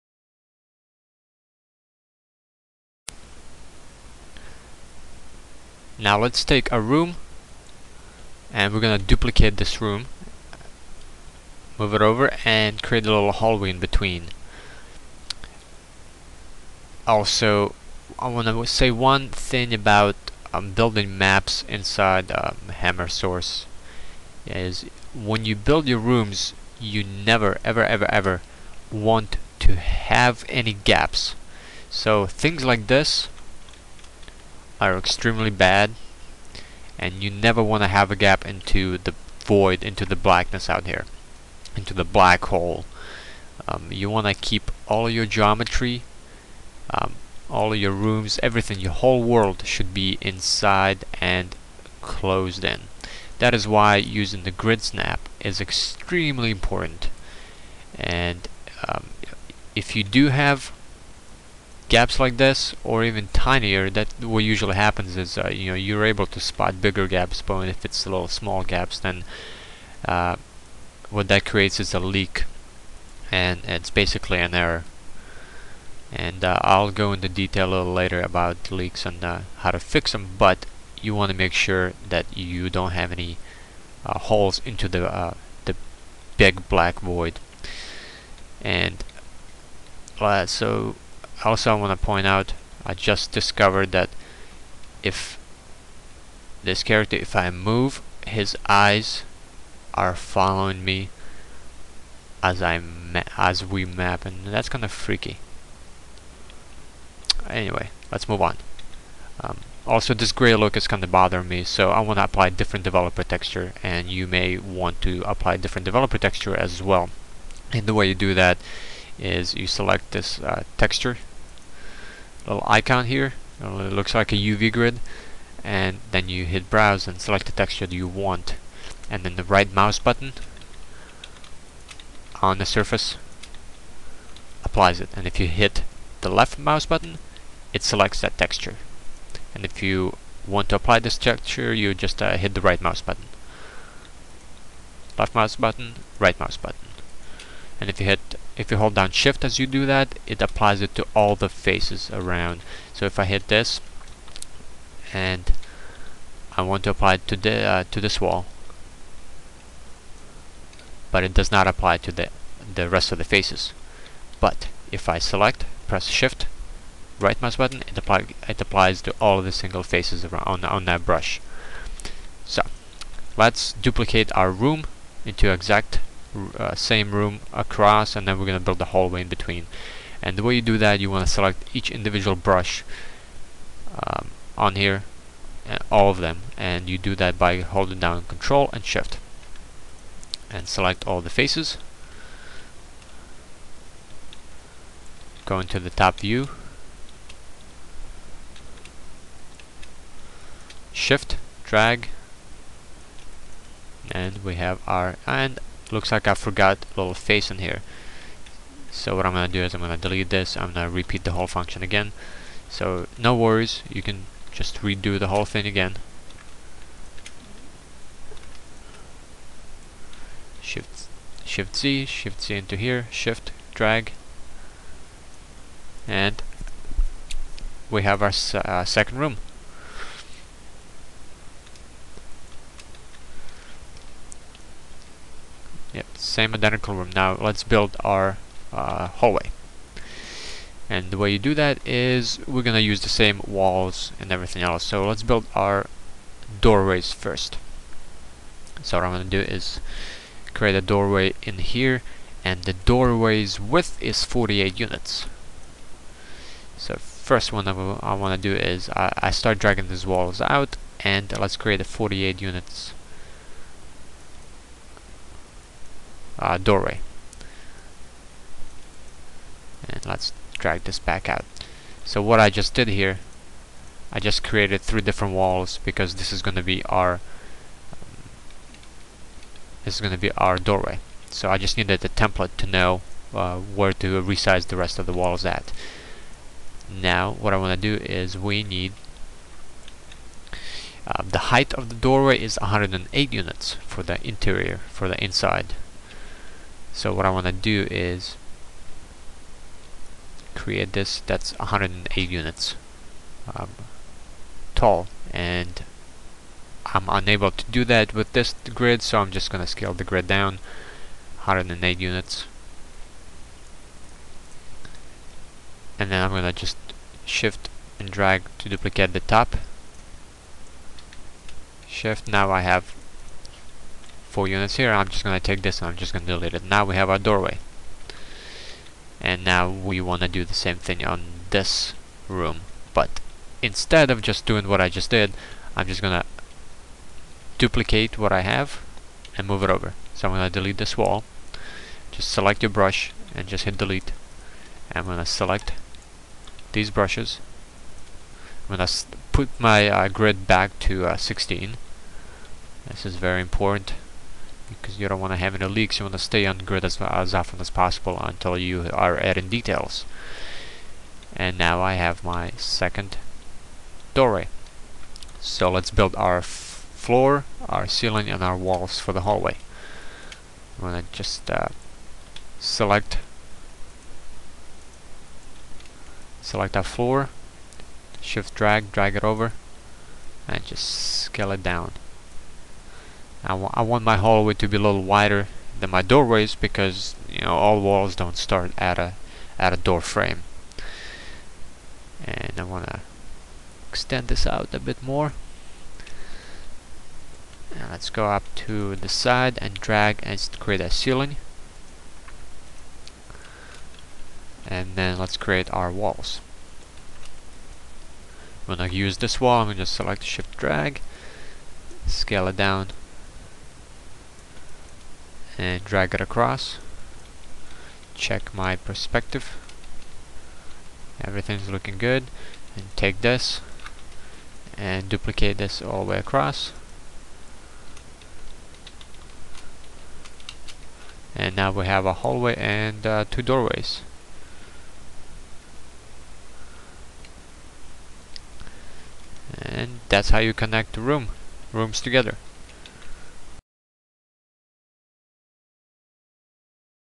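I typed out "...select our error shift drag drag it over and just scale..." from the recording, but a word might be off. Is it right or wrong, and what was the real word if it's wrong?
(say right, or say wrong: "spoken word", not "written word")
wrong: "floor", not "error".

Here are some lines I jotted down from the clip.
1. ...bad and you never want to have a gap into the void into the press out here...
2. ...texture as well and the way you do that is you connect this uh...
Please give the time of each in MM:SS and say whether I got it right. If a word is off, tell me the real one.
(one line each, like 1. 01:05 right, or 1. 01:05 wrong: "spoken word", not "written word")
1. 00:35 wrong: "blackness", not "press"
2. 01:56 wrong: "select", not "connect".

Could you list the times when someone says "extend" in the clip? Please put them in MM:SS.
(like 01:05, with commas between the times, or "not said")
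06:33.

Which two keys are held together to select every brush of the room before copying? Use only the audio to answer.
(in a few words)
Control and Shift.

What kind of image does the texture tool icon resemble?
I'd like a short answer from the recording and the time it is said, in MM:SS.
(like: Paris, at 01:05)
A UV grid, at 02:04.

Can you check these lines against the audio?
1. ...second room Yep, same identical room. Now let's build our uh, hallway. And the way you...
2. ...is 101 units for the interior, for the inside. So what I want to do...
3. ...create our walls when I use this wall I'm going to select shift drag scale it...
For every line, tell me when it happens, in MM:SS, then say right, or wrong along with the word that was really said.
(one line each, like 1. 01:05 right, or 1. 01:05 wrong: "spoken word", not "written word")
1. 03:48 right
2. 04:52 wrong: "108", not "101"
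3. 06:45 right.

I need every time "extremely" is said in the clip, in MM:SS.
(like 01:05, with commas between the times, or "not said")
00:34, 00:55.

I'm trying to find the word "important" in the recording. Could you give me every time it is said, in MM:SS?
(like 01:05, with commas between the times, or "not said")
00:56, 05:53.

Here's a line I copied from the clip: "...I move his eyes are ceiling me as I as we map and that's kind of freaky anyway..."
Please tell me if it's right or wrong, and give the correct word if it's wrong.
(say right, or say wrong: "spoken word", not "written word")
wrong: "following", not "ceiling".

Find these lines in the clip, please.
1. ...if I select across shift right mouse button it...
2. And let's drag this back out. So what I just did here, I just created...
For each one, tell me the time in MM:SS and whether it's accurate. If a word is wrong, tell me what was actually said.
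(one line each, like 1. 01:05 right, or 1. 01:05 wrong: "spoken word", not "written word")
1. 02:44 wrong: "press", not "across"
2. 04:29 right.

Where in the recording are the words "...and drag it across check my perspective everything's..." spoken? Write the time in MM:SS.
06:55.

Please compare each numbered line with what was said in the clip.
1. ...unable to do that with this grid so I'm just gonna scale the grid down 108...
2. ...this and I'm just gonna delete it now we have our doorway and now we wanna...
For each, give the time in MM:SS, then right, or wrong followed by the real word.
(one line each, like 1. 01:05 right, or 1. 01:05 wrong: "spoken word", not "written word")
1. 05:07 right
2. 05:25 right.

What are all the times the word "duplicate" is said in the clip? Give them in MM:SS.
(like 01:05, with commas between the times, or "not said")
00:08, 02:53, 05:18, 05:37, 07:05.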